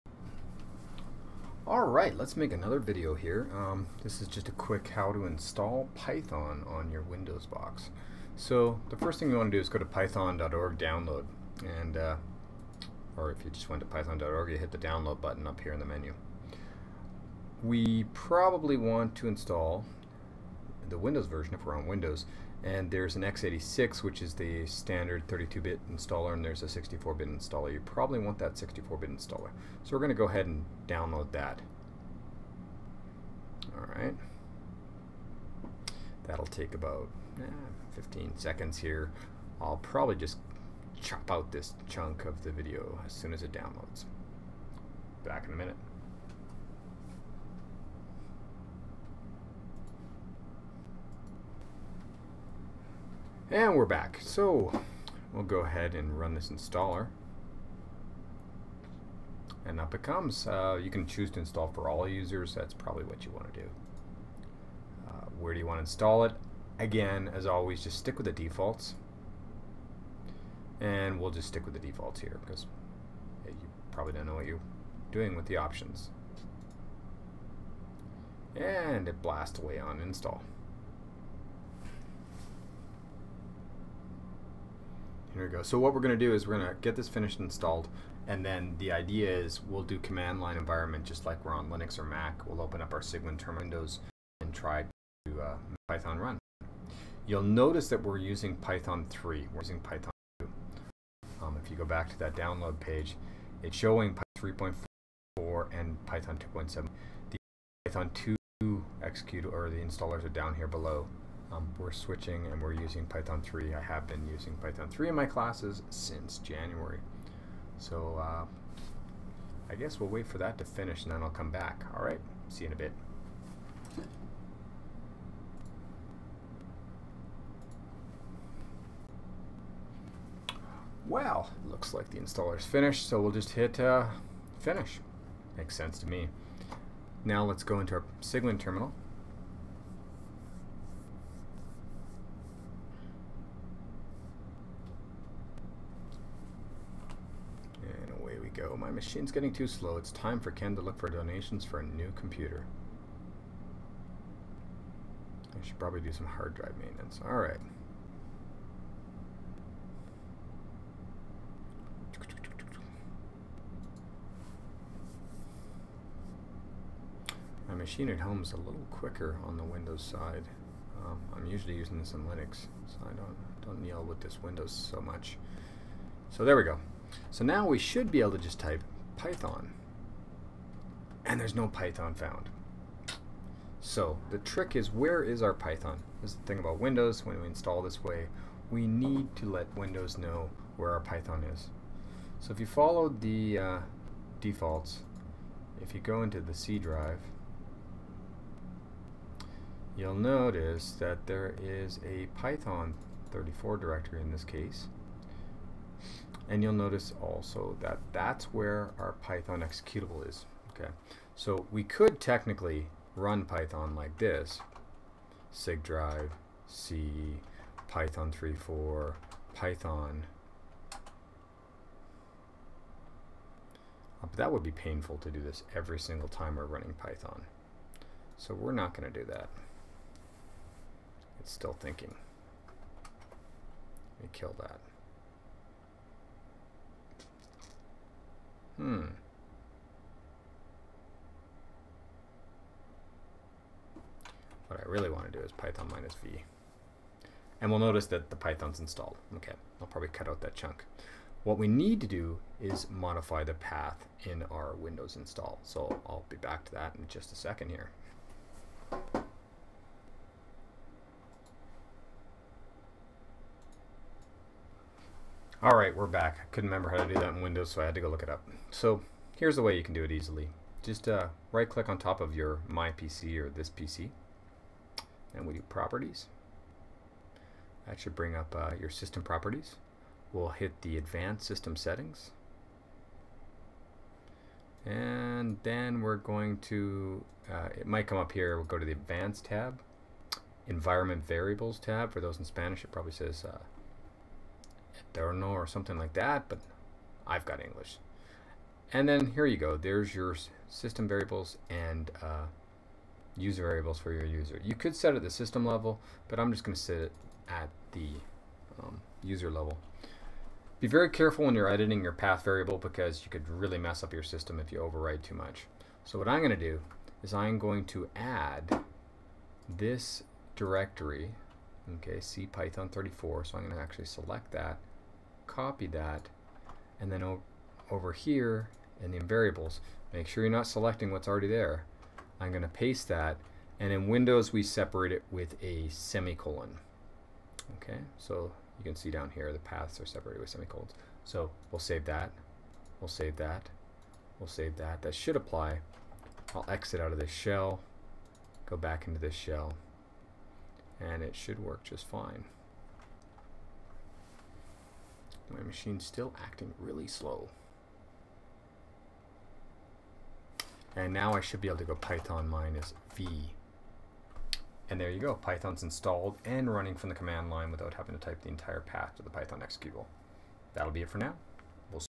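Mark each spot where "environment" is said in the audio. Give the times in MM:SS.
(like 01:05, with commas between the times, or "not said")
01:30, 04:50.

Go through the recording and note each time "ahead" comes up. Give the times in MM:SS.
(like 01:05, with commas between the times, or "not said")
00:30, 00:55.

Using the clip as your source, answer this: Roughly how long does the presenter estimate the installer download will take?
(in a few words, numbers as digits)
15 seconds.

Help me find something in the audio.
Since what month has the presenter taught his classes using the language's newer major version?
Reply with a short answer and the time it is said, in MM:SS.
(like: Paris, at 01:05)
January, at 01:56.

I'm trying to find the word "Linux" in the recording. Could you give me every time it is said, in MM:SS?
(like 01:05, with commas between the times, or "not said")
01:31, 02:52.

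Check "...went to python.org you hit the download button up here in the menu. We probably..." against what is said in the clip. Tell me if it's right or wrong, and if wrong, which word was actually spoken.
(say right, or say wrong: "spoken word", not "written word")
right.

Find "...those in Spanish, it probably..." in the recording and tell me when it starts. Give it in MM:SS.
04:52.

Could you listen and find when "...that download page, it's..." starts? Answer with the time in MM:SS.
01:42.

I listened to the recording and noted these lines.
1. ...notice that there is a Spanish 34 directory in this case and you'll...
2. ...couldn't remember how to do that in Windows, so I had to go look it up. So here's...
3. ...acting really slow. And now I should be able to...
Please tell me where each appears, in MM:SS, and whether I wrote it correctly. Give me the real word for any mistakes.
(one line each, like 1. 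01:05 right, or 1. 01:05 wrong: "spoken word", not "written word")
1. 03:20 wrong: "Python", not "Spanish"
2. 04:26 right
3. 05:56 right.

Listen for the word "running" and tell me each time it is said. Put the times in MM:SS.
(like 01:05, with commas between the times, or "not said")
03:46, 06:06.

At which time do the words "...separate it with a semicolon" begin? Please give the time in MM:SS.
05:34.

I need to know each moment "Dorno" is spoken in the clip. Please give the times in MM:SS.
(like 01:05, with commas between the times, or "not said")
04:55.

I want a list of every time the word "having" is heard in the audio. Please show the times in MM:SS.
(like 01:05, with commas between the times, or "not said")
06:07.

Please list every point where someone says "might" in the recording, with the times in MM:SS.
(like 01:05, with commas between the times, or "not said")
04:47.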